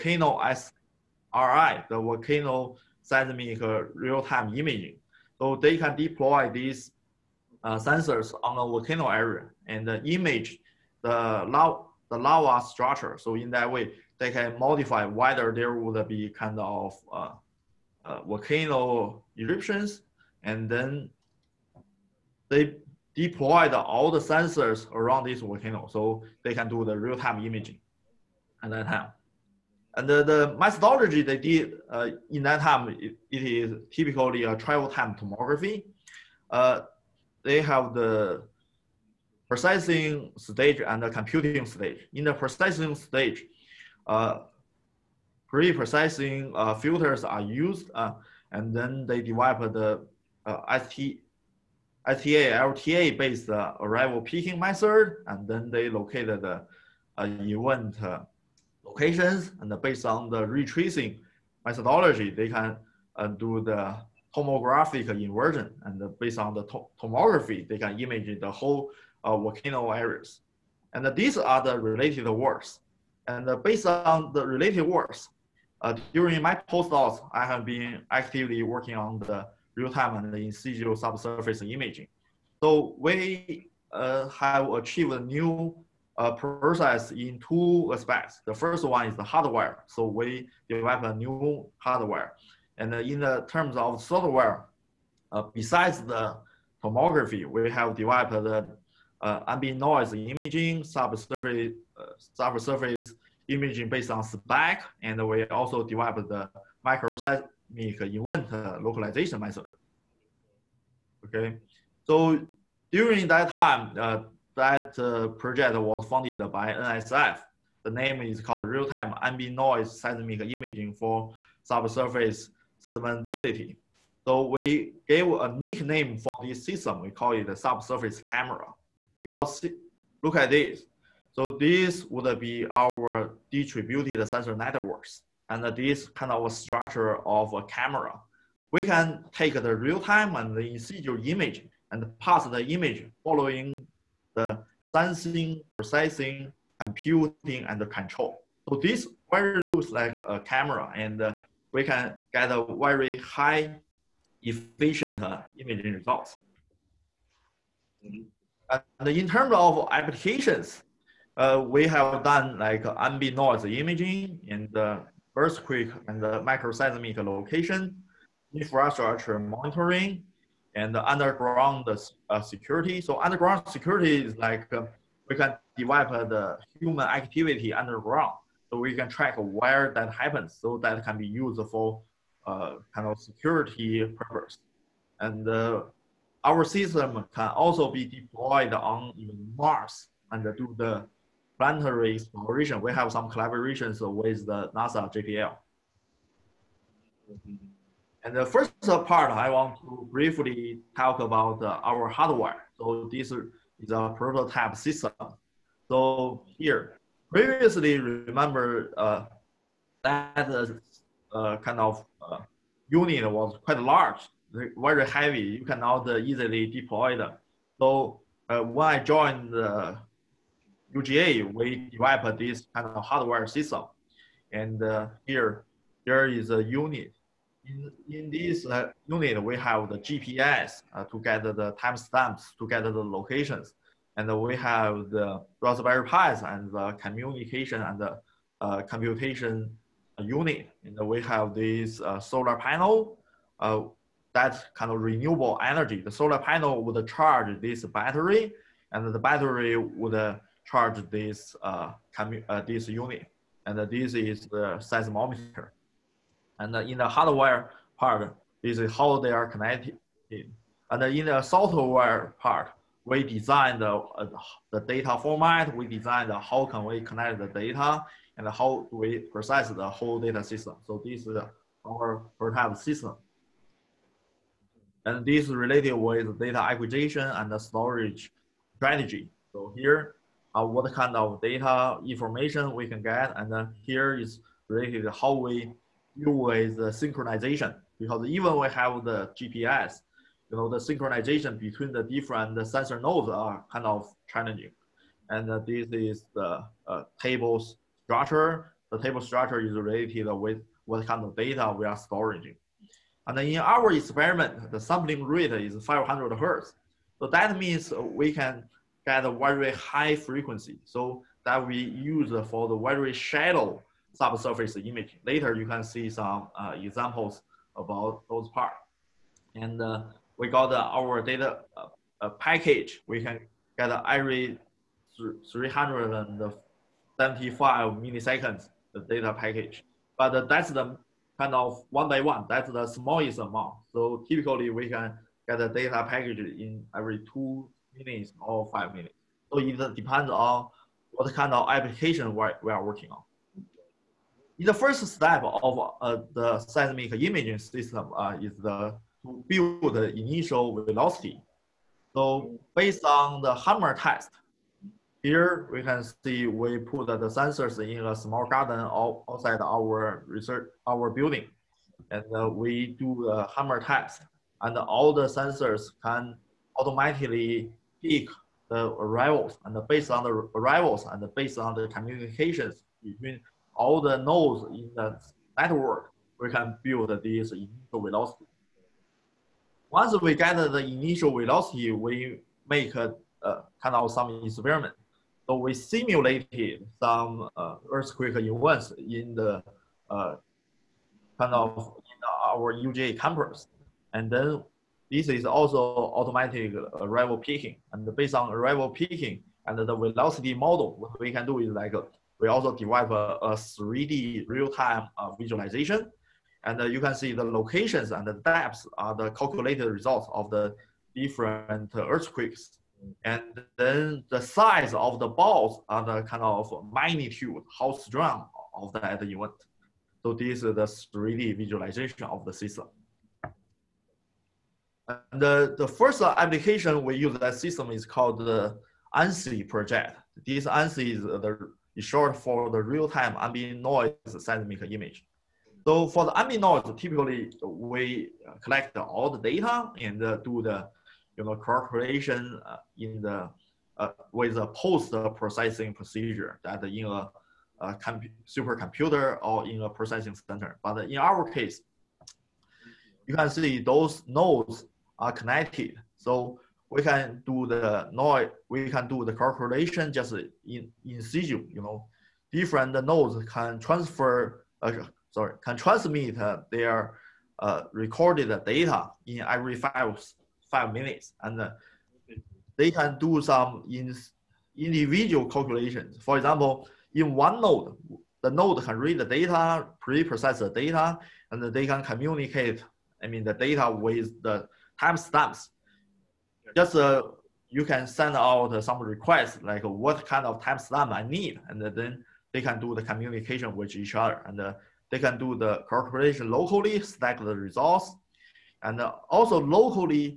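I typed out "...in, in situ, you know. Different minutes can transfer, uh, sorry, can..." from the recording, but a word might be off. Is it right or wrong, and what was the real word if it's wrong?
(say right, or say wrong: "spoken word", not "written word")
wrong: "nodes", not "minutes".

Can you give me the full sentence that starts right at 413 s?
And then the size of the balls are the kind of magnitude, how strong of that event.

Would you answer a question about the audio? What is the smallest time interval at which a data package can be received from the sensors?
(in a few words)
375 milliseconds.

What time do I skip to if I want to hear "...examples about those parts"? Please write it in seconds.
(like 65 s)
316 s.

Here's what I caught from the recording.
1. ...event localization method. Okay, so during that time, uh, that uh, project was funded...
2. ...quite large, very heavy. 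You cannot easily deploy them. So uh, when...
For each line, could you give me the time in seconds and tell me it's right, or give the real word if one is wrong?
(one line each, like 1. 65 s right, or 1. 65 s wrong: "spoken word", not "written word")
1. 107 s right
2. 213 s right.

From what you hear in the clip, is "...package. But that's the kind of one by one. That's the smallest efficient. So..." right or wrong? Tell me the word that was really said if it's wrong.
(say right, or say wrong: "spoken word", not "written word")
wrong: "amount", not "efficient".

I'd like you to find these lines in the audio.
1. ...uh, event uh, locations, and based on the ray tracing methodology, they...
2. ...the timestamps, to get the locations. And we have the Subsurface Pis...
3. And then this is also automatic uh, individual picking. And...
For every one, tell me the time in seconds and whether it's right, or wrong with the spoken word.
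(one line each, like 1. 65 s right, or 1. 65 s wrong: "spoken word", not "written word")
1. 57 s right
2. 231 s wrong: "Raspberry", not "Subsurface"
3. 394 s wrong: "arrival", not "individual".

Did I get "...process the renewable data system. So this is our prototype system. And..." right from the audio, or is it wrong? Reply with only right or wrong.
wrong.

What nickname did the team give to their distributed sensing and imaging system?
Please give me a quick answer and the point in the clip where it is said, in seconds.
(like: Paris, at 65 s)
subsurface camera, at 127 s.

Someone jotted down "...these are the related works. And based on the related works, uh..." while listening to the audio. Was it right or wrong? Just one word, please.
right.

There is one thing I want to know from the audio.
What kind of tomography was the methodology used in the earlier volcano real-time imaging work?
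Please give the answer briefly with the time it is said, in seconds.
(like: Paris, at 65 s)
travel time tomography, at 34 s.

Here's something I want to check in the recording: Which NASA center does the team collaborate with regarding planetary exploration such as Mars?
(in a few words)
JPL.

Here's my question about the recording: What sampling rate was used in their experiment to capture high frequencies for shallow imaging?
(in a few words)
500 hertz.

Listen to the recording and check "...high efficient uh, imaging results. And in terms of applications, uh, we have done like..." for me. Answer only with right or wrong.
right.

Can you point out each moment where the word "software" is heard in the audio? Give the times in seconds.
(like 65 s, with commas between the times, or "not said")
94 s, 261 s.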